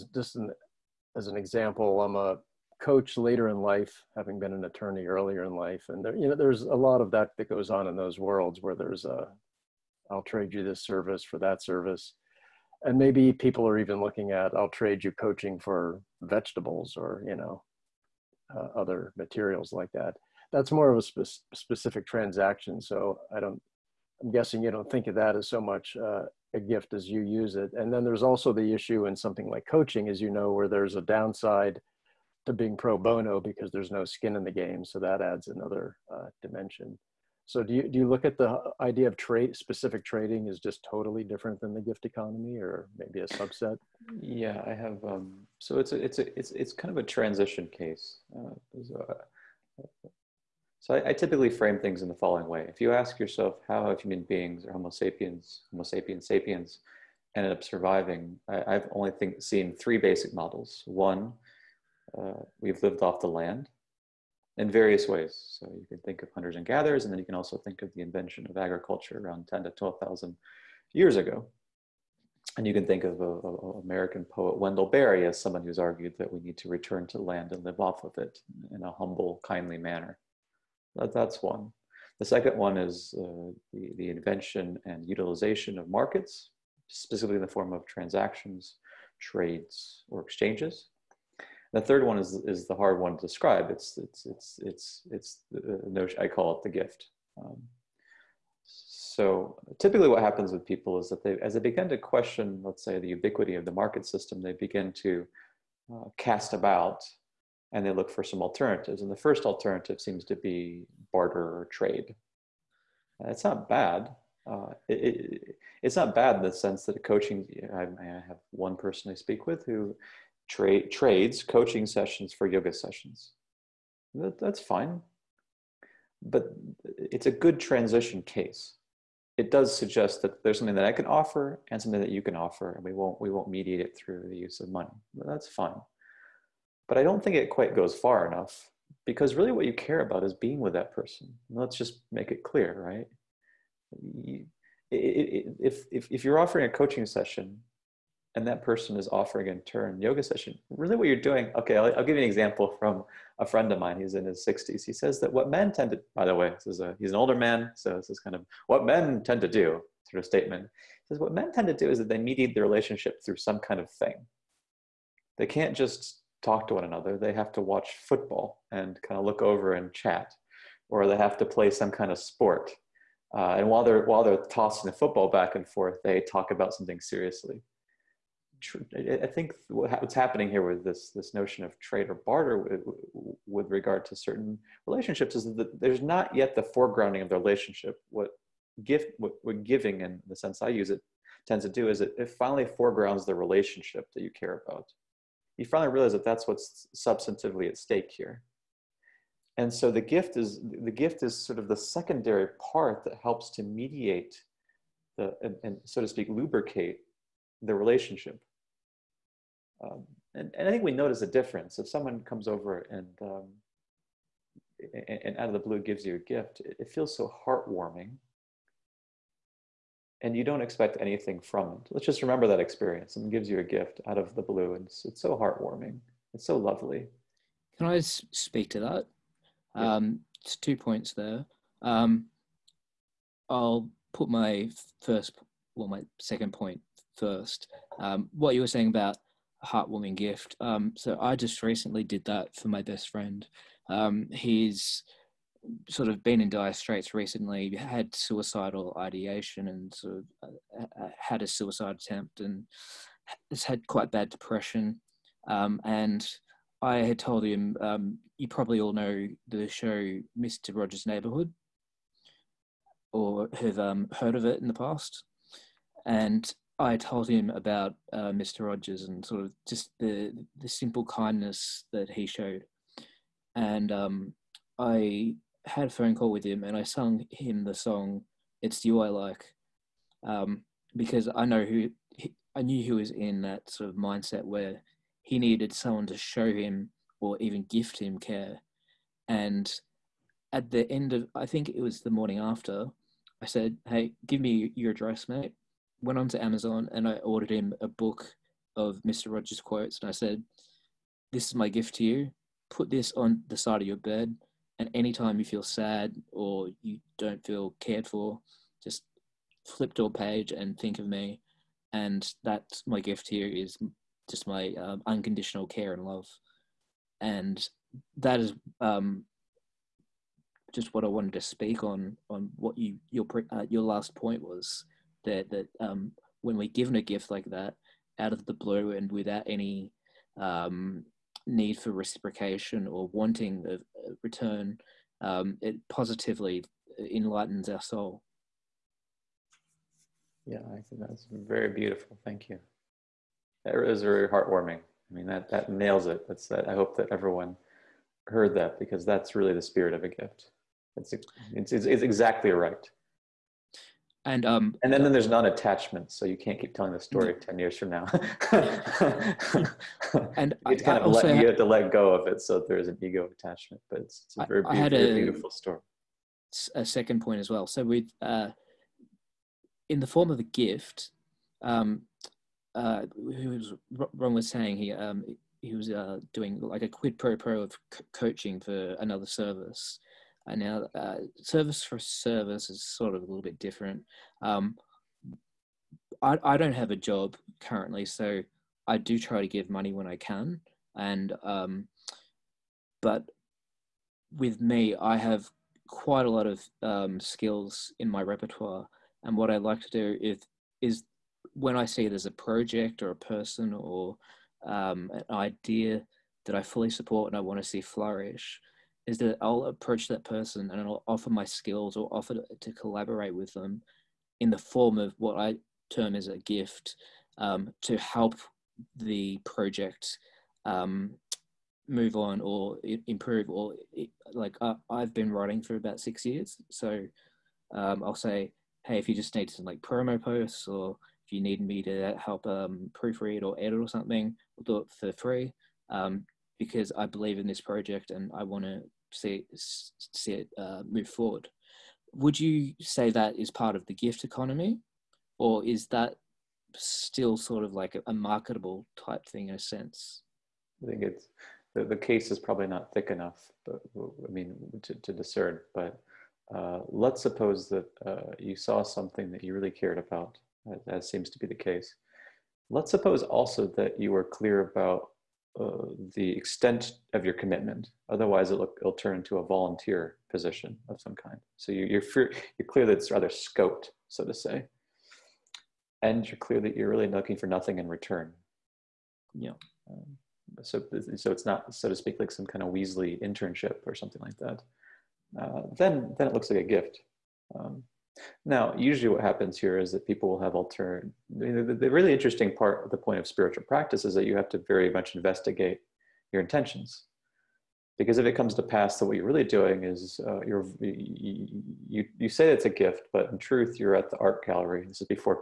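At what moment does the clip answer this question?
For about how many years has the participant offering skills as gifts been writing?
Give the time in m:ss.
7:05.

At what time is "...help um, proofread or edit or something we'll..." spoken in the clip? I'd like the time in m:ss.
7:12.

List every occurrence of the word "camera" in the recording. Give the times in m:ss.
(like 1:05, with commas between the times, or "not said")
not said.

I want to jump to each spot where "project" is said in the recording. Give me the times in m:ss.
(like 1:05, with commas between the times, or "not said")
6:42, 6:59, 7:17.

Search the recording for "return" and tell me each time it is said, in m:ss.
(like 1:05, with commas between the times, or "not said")
1:16, 5:34, 7:57.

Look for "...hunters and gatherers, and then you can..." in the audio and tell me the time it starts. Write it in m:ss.
1:06.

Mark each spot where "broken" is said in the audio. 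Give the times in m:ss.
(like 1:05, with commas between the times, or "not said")
not said.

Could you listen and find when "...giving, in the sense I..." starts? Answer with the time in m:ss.
3:09.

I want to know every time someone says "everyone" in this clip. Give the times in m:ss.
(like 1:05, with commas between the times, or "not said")
5:47.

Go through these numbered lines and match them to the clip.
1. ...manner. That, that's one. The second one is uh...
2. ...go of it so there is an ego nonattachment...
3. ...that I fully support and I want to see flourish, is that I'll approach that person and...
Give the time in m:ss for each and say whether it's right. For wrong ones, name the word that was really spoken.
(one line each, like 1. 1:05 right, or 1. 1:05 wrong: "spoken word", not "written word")
1. 1:19 right
2. 6:01 wrong: "attachment", not "nonattachment"
3. 6:46 right.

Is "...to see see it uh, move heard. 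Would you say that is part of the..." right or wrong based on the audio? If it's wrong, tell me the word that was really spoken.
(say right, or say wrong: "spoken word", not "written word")
wrong: "forward", not "heard".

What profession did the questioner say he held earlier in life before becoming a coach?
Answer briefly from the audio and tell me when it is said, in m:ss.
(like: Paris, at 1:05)
Attorney, at 0:04.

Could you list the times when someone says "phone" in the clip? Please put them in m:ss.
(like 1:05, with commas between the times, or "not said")
4:35.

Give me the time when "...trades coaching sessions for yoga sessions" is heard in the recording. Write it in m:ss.
2:00.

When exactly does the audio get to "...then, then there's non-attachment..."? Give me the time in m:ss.
5:54.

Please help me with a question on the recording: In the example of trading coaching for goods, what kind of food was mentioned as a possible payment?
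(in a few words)
Vegetables.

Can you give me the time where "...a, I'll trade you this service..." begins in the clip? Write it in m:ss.
0:09.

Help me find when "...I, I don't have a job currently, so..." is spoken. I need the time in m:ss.
6:26.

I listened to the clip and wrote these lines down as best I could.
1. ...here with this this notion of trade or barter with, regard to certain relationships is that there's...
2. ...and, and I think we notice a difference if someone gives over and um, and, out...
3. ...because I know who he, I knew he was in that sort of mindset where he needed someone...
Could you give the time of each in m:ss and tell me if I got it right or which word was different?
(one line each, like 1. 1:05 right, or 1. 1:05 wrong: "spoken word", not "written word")
1. 3:00 right
2. 3:30 wrong: "comes", not "gives"
3. 4:40 right.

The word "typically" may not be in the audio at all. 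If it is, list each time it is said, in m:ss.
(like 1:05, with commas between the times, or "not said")
0:51, 1:39.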